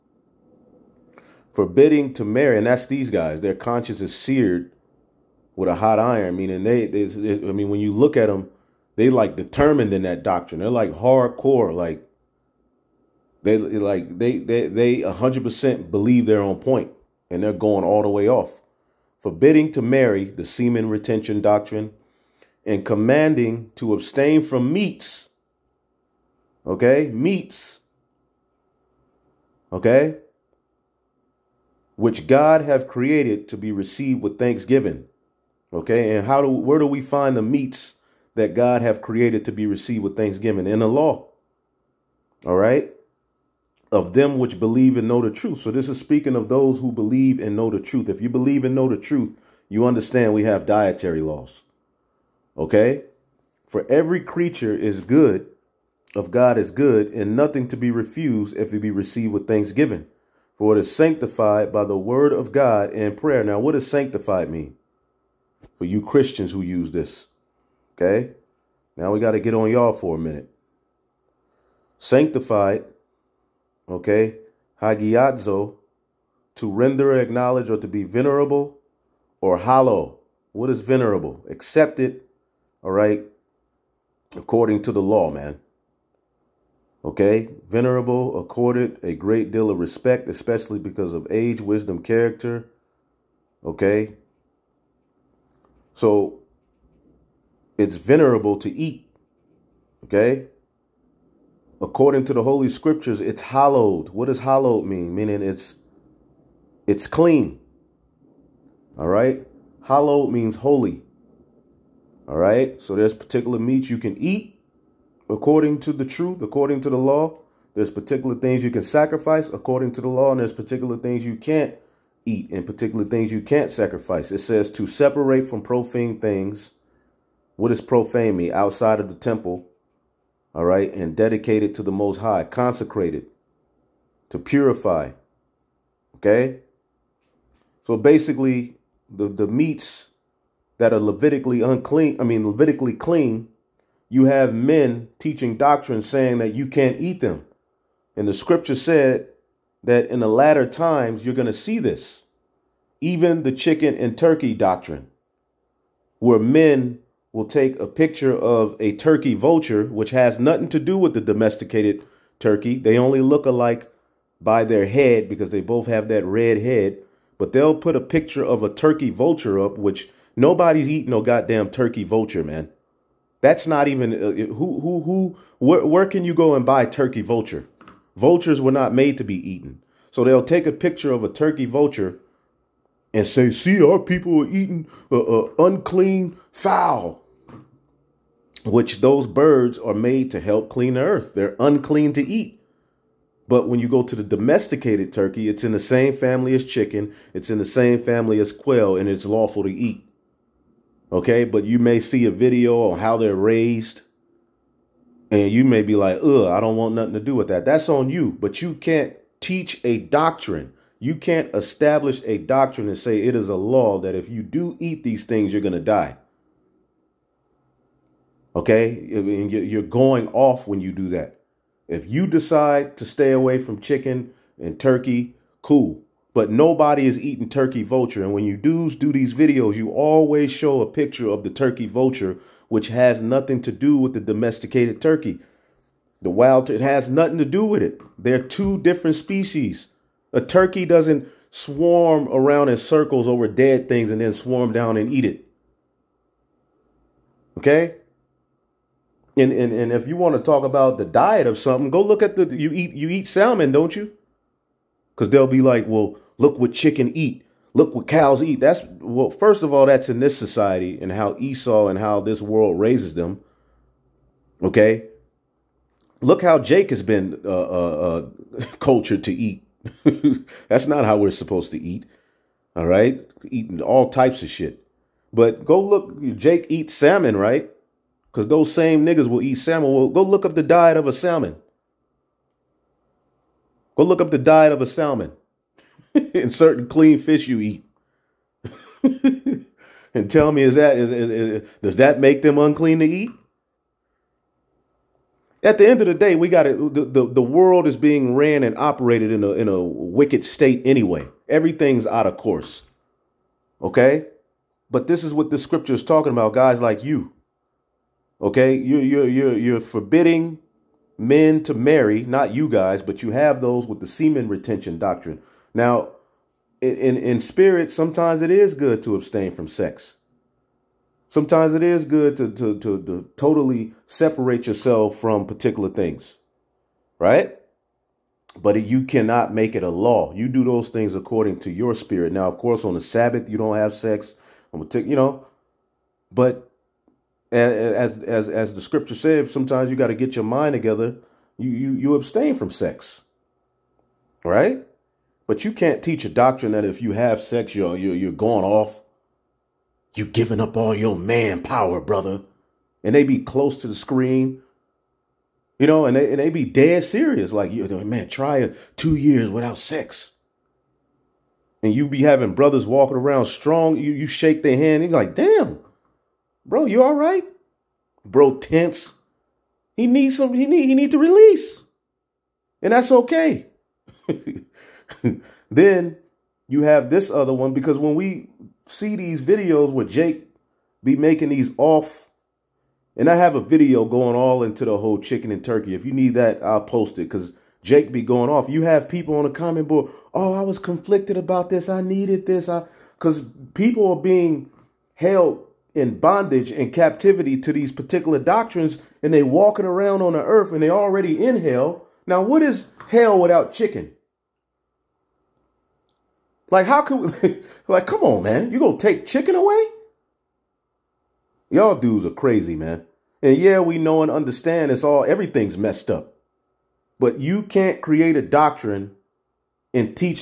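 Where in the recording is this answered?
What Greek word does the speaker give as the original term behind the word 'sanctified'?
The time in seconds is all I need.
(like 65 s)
74 s.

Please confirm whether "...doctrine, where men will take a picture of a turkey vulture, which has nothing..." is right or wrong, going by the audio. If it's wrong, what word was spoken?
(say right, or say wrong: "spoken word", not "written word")
right.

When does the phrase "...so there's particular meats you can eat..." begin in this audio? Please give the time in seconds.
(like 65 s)
112 s.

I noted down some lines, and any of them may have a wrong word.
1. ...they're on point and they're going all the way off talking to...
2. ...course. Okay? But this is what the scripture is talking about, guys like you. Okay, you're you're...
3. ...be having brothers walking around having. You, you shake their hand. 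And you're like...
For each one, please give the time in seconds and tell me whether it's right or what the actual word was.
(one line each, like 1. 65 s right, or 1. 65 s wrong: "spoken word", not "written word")
1. 16 s wrong: "forbidding", not "talking"
2. 302 s right
3. 362 s wrong: "strong", not "having".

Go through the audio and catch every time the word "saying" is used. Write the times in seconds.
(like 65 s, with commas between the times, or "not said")
146 s.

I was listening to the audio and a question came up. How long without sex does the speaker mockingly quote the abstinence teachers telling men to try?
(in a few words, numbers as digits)
2 years.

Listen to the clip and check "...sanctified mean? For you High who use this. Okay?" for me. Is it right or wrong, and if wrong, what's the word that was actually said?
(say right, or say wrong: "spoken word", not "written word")
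wrong: "Christians", not "High".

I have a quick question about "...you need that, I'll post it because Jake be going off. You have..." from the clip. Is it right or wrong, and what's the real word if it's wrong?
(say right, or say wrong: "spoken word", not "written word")
right.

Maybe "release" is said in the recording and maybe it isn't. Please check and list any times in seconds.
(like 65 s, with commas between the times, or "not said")
371 s.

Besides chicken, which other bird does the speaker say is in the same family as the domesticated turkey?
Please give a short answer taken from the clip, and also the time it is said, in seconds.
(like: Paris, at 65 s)
quail, at 198 s.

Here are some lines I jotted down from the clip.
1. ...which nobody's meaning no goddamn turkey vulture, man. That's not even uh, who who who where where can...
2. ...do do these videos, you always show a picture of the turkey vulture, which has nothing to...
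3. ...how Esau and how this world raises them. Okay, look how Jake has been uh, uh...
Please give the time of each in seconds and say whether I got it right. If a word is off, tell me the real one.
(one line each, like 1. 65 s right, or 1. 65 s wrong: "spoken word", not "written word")
1. 169 s wrong: "eating", not "meaning"
2. 228 s right
3. 261 s right.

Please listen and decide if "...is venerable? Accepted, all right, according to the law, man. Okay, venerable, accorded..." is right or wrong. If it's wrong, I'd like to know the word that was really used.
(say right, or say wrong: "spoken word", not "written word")
right.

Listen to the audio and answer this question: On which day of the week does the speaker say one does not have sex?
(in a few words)
Sabbath.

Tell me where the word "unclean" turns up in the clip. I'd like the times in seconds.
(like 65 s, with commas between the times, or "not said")
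141 s, 185 s, 191 s, 292 s.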